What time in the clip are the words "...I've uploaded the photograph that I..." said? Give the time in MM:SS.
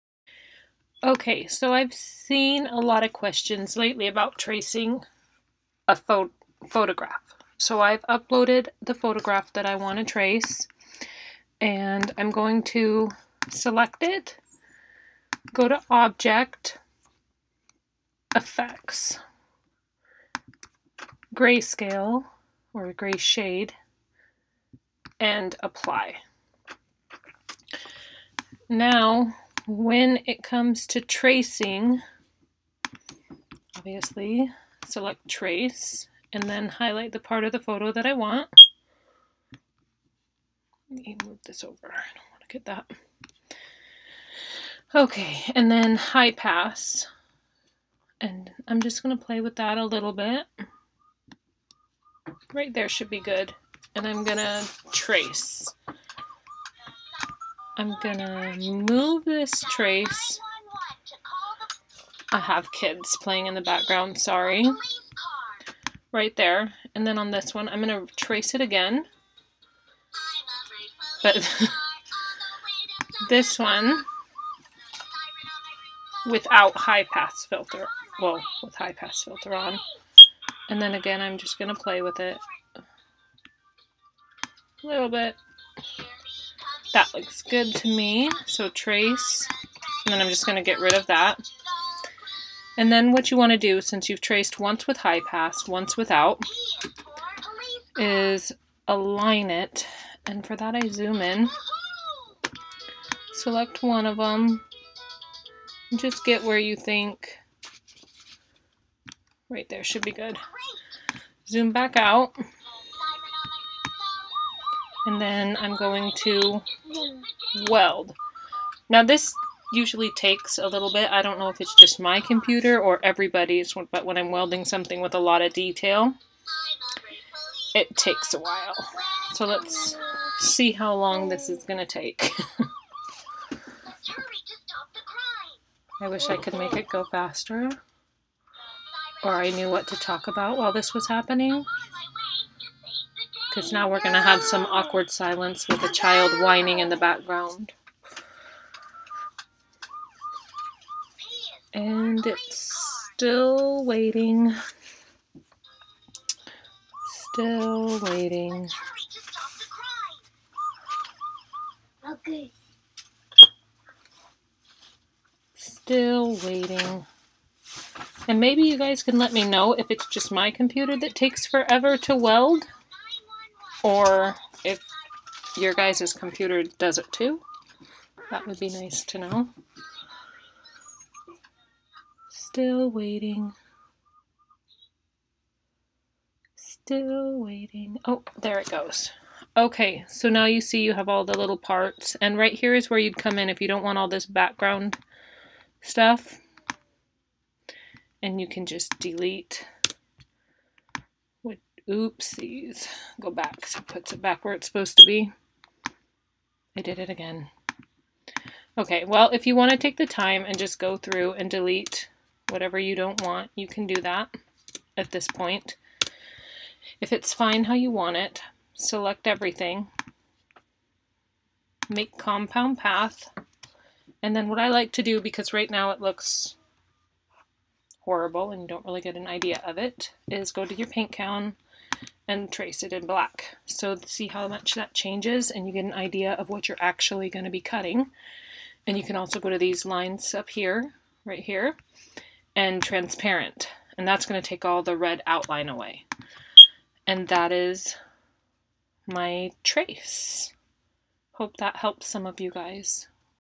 00:07.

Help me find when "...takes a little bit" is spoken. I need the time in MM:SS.
02:00.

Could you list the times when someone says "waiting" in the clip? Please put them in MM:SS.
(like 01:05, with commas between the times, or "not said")
02:33, 02:38, 02:46, 03:02, 03:07.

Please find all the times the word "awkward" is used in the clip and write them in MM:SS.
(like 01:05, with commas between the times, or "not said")
02:24.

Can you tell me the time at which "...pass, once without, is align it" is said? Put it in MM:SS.
01:35.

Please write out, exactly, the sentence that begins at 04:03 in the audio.
And that's going to take all the red outline away.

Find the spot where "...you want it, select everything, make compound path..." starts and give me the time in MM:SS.
03:37.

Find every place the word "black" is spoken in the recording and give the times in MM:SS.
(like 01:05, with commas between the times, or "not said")
03:53.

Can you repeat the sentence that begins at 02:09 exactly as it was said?
So let's see how long this is going to take.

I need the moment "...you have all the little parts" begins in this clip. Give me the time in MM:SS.
03:10.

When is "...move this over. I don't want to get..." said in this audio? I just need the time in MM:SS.
00:41.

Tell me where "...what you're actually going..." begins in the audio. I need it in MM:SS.
03:56.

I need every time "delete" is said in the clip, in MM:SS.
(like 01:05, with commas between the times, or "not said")
03:18, 03:31.